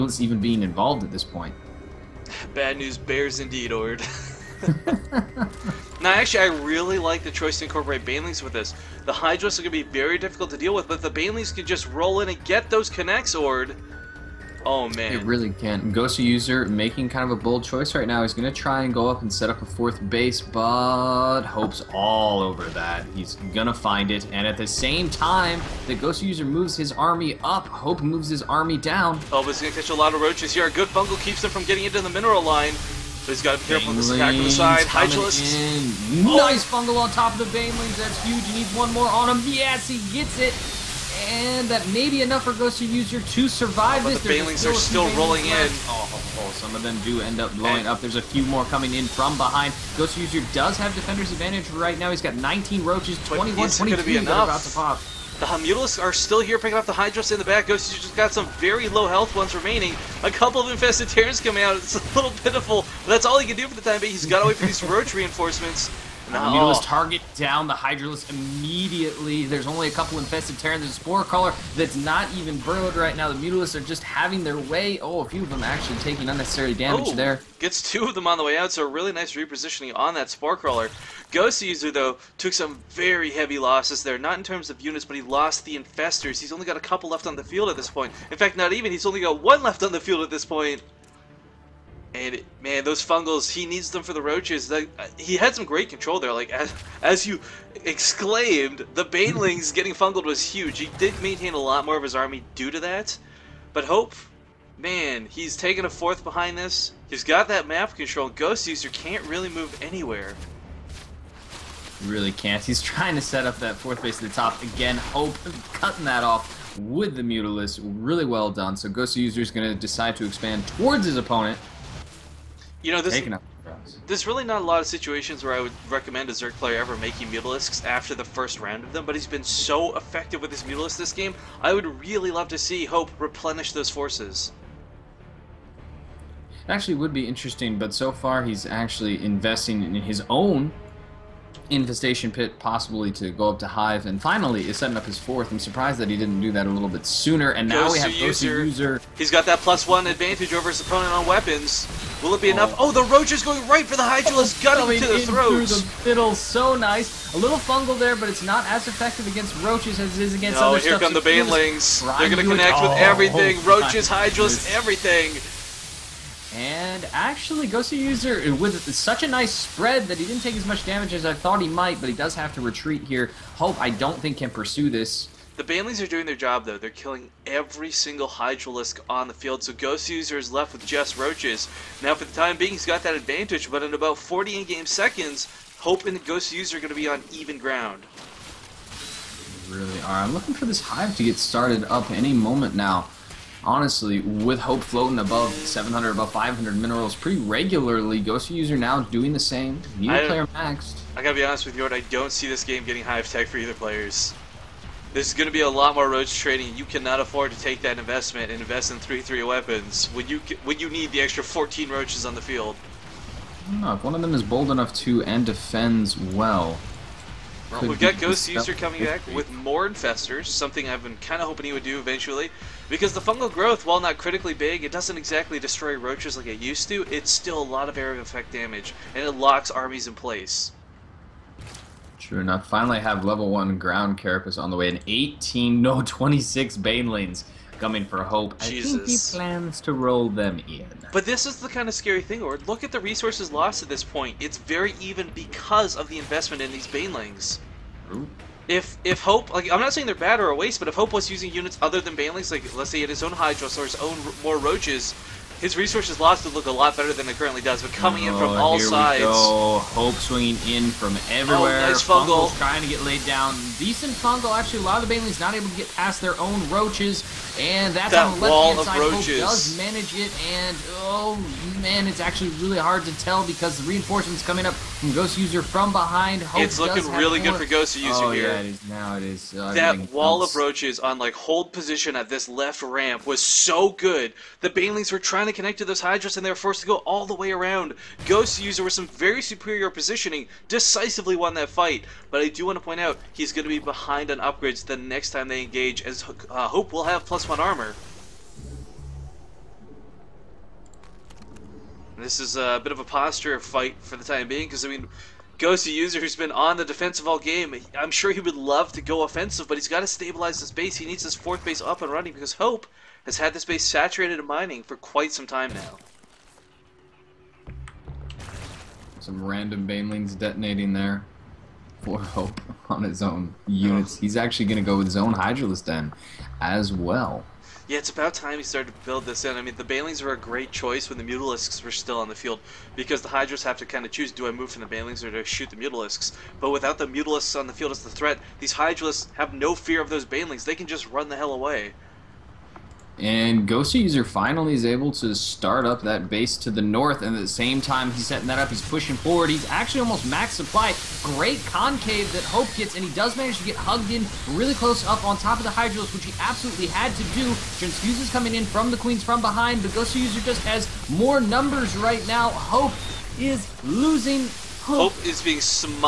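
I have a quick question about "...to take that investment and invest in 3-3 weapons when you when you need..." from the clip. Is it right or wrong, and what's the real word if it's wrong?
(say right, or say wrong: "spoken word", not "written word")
right.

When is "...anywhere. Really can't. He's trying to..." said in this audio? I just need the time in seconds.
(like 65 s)
109 s.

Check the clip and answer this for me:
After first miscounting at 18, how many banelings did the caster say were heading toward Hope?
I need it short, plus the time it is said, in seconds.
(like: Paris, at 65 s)
26, at 236 s.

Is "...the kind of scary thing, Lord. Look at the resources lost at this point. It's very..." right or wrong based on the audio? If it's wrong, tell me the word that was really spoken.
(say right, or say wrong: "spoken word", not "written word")
right.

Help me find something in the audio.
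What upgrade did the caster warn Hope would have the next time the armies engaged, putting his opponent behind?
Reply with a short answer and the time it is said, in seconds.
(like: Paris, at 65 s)
+1 armor, at 297 s.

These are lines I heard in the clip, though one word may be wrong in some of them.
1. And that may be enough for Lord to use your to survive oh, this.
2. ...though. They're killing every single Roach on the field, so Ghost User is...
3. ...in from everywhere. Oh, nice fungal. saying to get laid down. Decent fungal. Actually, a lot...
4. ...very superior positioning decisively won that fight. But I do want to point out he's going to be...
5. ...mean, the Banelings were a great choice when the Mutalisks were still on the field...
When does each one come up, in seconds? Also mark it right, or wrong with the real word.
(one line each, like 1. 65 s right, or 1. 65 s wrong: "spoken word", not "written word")
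1. 41 s wrong: "Ghost", not "Lord"
2. 176 s wrong: "Hydralisk", not "Roach"
3. 260 s wrong: "trying", not "saying"
4. 289 s right
5. 329 s right.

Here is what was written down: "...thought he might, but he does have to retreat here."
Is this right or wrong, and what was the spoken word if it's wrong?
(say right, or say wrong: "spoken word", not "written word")
right.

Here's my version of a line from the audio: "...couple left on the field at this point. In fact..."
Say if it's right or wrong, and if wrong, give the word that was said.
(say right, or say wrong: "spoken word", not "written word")
right.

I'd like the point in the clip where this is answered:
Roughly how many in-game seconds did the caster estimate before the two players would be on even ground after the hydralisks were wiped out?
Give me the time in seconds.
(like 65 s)
184 s.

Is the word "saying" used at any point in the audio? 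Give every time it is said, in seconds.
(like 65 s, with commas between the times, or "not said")
249 s.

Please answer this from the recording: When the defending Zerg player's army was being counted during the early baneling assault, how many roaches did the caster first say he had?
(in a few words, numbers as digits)
19.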